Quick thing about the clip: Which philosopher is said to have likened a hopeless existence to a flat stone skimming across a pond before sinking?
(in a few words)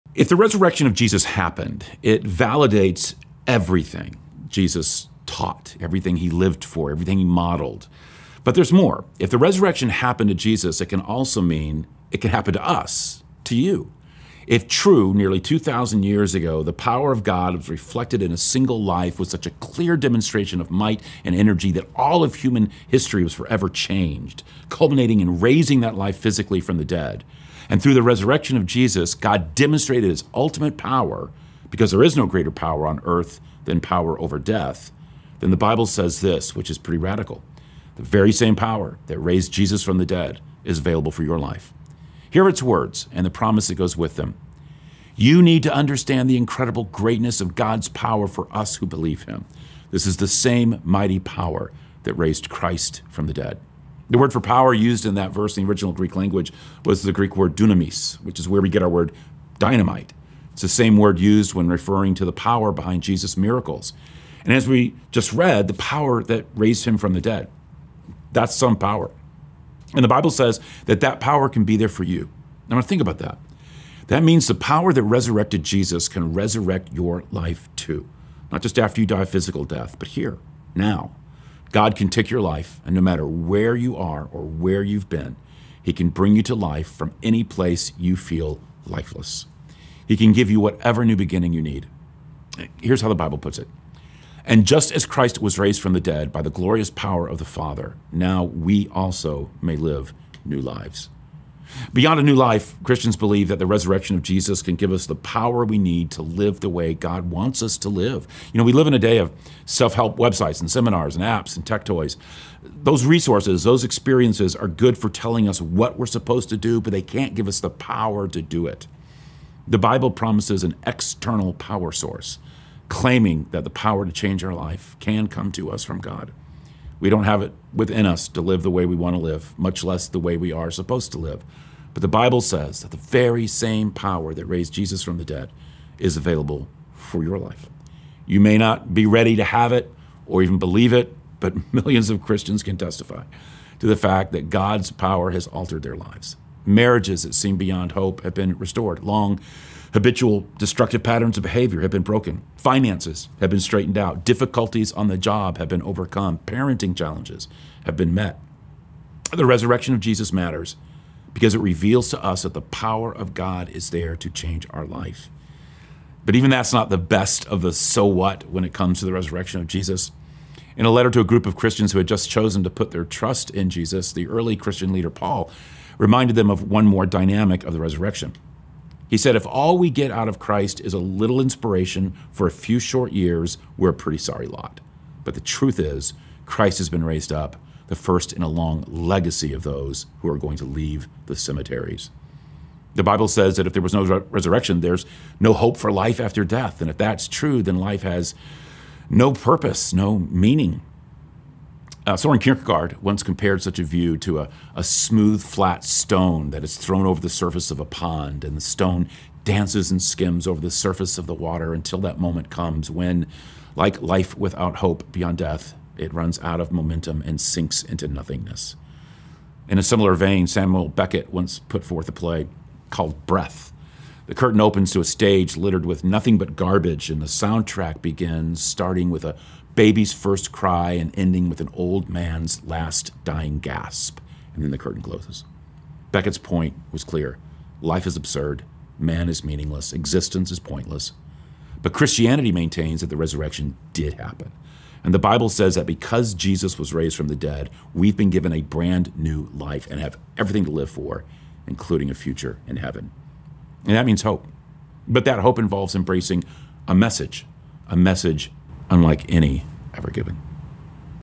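Soren Kierkegaard.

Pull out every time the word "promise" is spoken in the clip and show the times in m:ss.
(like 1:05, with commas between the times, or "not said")
0:43, 2:00.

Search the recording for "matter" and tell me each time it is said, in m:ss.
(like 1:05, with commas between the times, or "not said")
1:22, 2:40.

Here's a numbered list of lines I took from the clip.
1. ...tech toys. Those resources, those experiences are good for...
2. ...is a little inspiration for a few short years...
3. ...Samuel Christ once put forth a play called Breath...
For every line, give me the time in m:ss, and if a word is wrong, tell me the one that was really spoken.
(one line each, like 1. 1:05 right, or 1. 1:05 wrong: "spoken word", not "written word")
1. 1:51 right
2. 3:00 right
3. 3:40 wrong: "Beckett", not "Christ".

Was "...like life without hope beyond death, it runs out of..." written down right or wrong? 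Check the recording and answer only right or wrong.
right.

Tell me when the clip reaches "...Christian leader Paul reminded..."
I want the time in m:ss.
2:54.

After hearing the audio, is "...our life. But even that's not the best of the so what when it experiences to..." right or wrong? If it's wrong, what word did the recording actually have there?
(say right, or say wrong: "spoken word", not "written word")
wrong: "comes", not "experiences".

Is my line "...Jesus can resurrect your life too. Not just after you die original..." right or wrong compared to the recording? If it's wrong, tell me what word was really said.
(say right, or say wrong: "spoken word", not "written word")
wrong: "physical", not "original".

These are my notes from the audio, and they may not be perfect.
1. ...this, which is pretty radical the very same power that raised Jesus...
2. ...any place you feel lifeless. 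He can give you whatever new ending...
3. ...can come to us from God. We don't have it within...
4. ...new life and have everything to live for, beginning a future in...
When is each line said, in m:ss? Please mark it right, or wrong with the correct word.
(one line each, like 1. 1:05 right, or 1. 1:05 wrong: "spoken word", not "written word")
1. 0:36 right
2. 1:27 wrong: "beginning", not "ending"
3. 2:04 right
4. 4:09 wrong: "including", not "beginning".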